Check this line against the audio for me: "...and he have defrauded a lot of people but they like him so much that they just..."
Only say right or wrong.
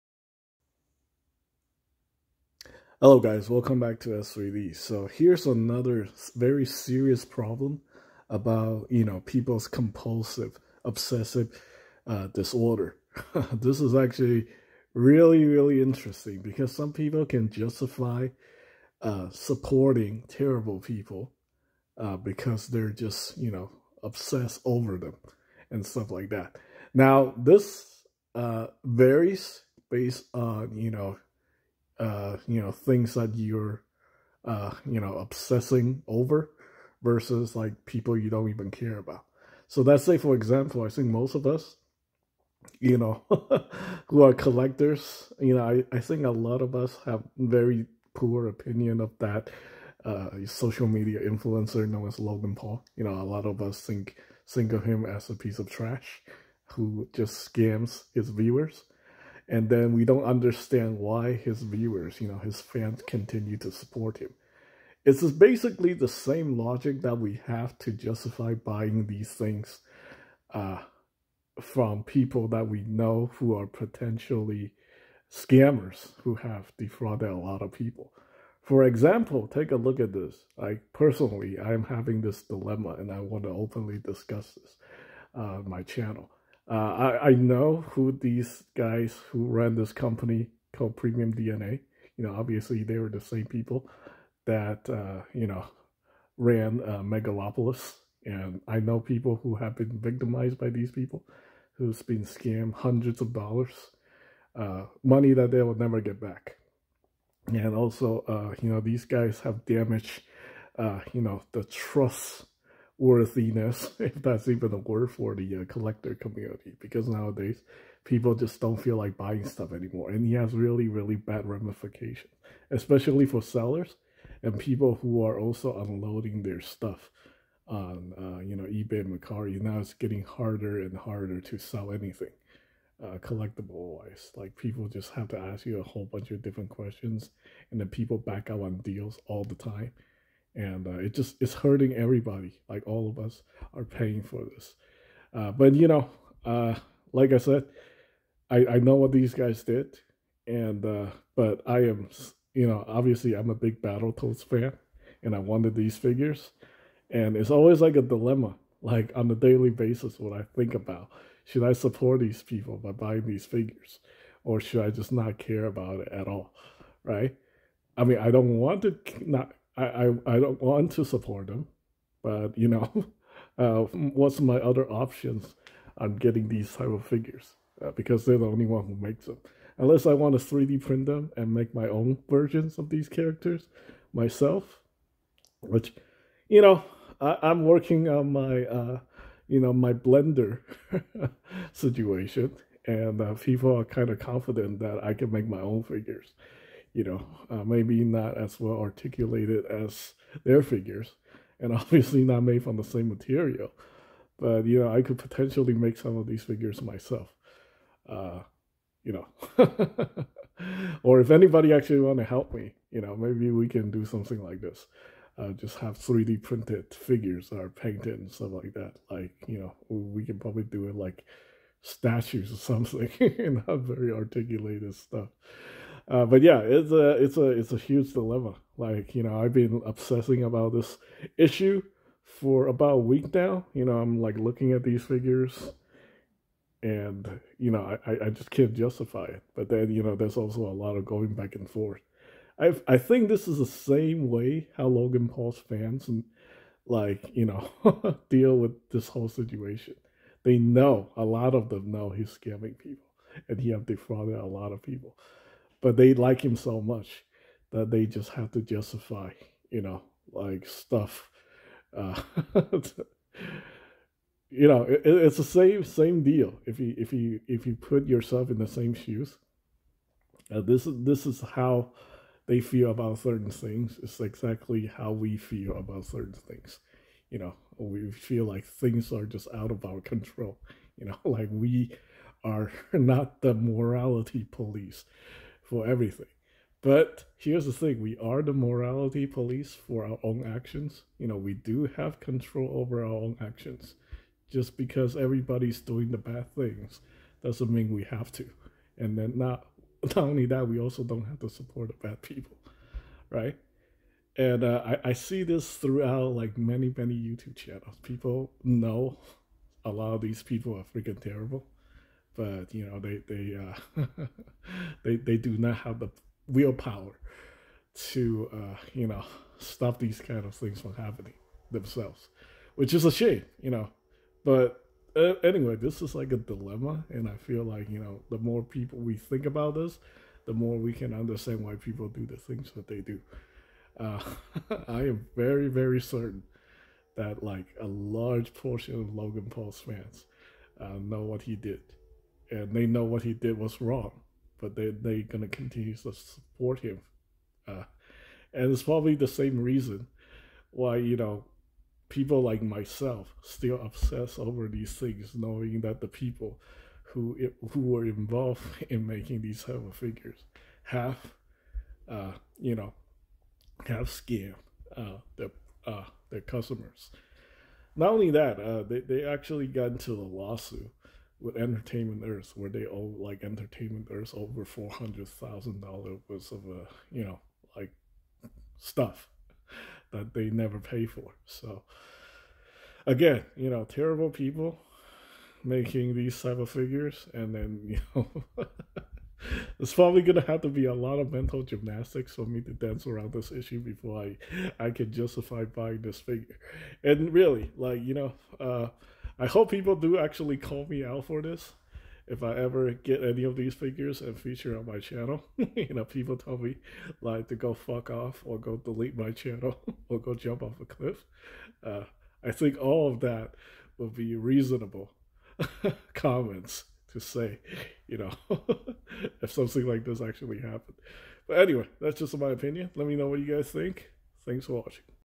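right.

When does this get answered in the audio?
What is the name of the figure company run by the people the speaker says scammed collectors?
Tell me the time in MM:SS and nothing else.
01:30.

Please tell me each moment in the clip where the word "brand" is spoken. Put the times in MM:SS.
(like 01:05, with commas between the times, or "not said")
not said.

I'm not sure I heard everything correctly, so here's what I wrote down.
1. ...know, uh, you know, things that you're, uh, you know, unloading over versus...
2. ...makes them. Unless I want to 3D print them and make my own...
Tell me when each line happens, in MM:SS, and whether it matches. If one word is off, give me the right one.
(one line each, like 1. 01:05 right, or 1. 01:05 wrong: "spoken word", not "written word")
1. 00:30 wrong: "obsessing", not "unloading"
2. 02:58 right.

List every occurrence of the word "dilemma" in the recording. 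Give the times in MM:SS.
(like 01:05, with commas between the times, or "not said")
01:22, 02:38, 03:48, 05:26.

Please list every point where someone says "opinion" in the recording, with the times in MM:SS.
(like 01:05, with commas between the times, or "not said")
00:48, 07:02.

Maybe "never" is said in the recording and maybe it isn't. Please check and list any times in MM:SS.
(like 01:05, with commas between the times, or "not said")
01:45, 06:20.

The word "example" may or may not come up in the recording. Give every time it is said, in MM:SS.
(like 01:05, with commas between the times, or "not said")
00:40, 01:18.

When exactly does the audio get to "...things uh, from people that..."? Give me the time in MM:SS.
01:09.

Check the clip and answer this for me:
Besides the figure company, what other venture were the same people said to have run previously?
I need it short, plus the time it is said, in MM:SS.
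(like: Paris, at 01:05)
Megalopolis, at 01:37.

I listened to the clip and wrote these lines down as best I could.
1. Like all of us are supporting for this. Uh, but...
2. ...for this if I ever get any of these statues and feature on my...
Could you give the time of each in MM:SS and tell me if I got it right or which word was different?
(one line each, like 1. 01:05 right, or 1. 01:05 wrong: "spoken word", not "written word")
1. 02:22 wrong: "paying", not "supporting"
2. 06:41 wrong: "figures", not "statues".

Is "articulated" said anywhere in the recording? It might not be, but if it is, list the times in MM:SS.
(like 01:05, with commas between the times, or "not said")
03:18, 03:44.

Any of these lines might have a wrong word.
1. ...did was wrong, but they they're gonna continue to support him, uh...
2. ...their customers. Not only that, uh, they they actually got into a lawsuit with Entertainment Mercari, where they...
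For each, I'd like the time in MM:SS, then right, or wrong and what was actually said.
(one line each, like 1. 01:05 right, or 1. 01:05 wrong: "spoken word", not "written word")
1. 05:43 right
2. 06:06 wrong: "Earth", not "Mercari".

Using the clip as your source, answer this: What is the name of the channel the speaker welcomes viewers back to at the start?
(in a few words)
S3D.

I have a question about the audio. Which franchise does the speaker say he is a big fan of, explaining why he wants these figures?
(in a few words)
Battletoads.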